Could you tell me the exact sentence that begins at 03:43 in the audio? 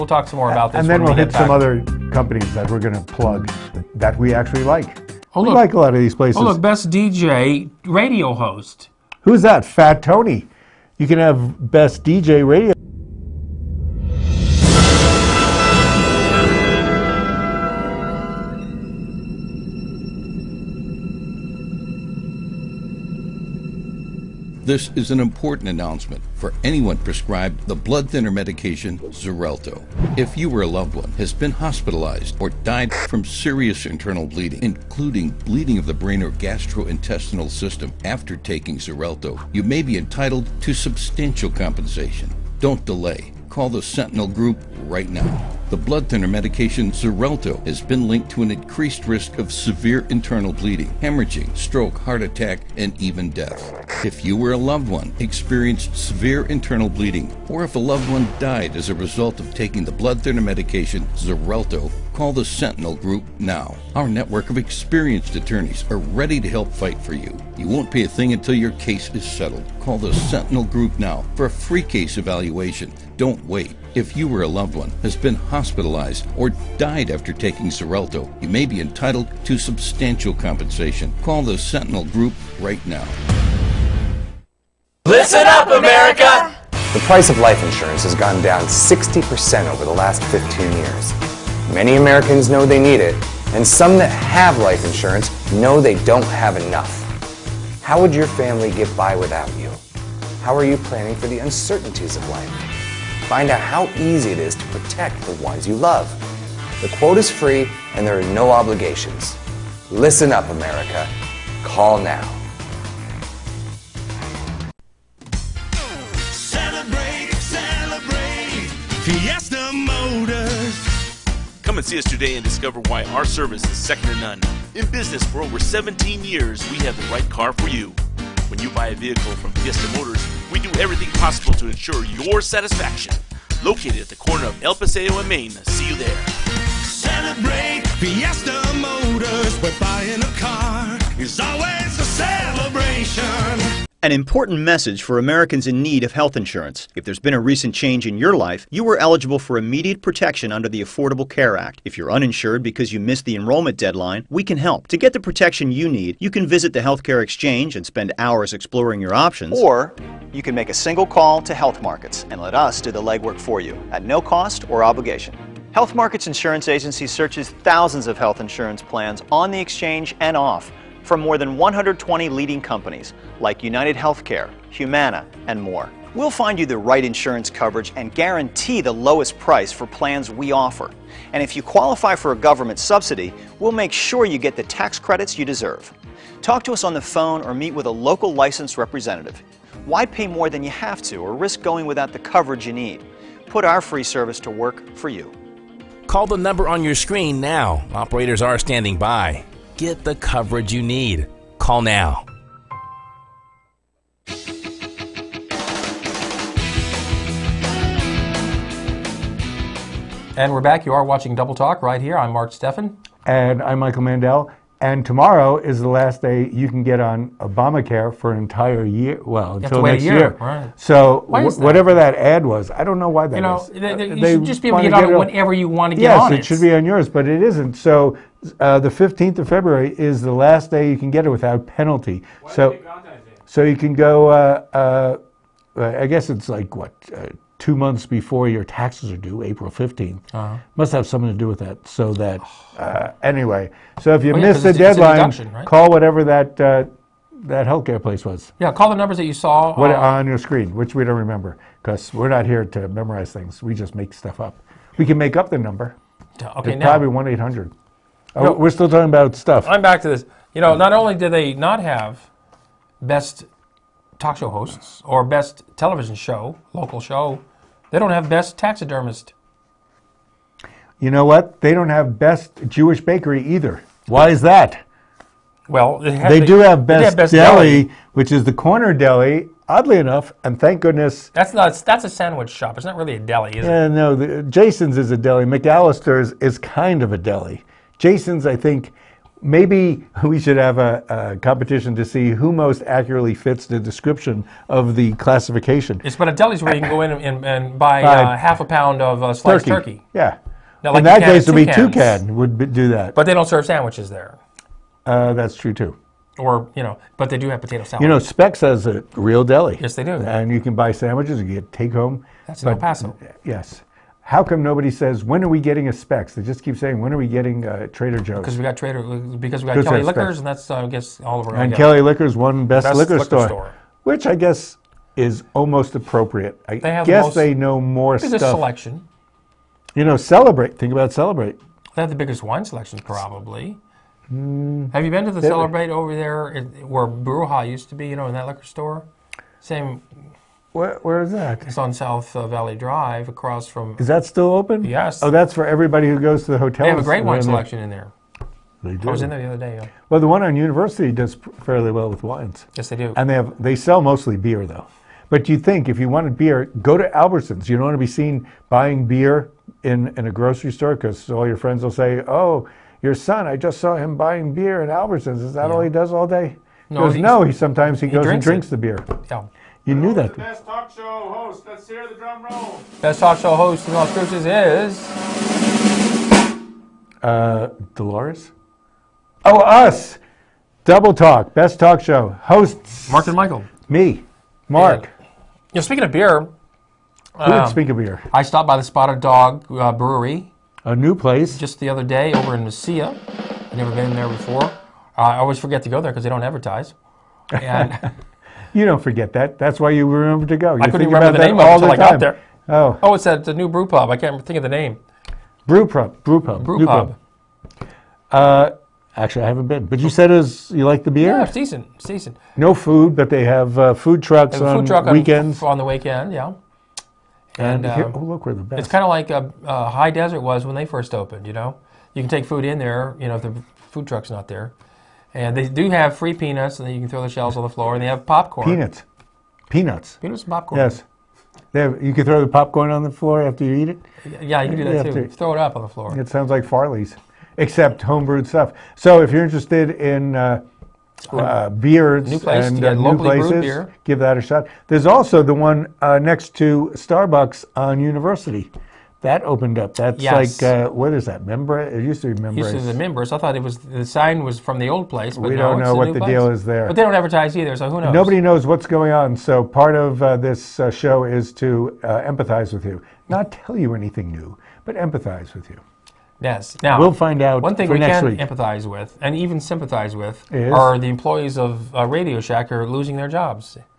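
Th- th- uh, you they should just be able to get, get on it whenever you want to get yes, on it.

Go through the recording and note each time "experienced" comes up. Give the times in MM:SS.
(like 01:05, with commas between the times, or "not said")
00:55, 01:04.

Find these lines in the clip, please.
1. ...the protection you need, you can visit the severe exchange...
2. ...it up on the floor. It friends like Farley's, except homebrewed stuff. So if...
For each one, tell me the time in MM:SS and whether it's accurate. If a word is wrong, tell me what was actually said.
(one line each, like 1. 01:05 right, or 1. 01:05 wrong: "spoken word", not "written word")
1. 02:35 wrong: "healthcare", not "severe"
2. 07:15 wrong: "sounds", not "friends".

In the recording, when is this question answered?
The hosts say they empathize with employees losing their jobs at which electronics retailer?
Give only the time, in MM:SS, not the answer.
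07:52.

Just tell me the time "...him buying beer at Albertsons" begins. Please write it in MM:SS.
06:03.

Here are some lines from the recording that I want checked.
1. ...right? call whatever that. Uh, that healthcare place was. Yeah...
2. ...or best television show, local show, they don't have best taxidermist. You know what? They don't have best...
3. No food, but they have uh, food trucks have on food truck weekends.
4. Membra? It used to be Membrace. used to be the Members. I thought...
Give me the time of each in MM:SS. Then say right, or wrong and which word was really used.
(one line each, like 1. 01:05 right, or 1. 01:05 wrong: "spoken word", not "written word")
1. 04:05 right
2. 04:25 right
3. 06:52 right
4. 07:31 right.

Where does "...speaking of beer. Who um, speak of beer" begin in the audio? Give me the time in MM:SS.
06:25.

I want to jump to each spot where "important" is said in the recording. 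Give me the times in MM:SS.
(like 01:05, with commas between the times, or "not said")
00:25, 02:24.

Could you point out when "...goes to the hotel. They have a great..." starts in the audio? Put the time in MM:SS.
05:46.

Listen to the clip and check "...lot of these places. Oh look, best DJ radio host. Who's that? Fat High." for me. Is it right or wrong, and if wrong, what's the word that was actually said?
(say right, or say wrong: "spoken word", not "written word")
wrong: "Tony", not "High".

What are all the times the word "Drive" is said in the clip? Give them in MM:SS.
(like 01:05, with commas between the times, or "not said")
05:42.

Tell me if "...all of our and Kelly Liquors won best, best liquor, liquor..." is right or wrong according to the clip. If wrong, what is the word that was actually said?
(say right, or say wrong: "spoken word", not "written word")
right.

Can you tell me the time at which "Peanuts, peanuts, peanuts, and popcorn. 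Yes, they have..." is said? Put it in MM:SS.
07:08.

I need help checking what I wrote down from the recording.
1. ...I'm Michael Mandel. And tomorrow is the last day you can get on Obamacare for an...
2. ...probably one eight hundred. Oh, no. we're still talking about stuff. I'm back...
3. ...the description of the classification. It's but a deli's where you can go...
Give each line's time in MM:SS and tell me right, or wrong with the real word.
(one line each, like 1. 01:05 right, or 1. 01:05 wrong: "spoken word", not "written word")
1. 03:33 right
2. 04:16 right
3. 04:53 right.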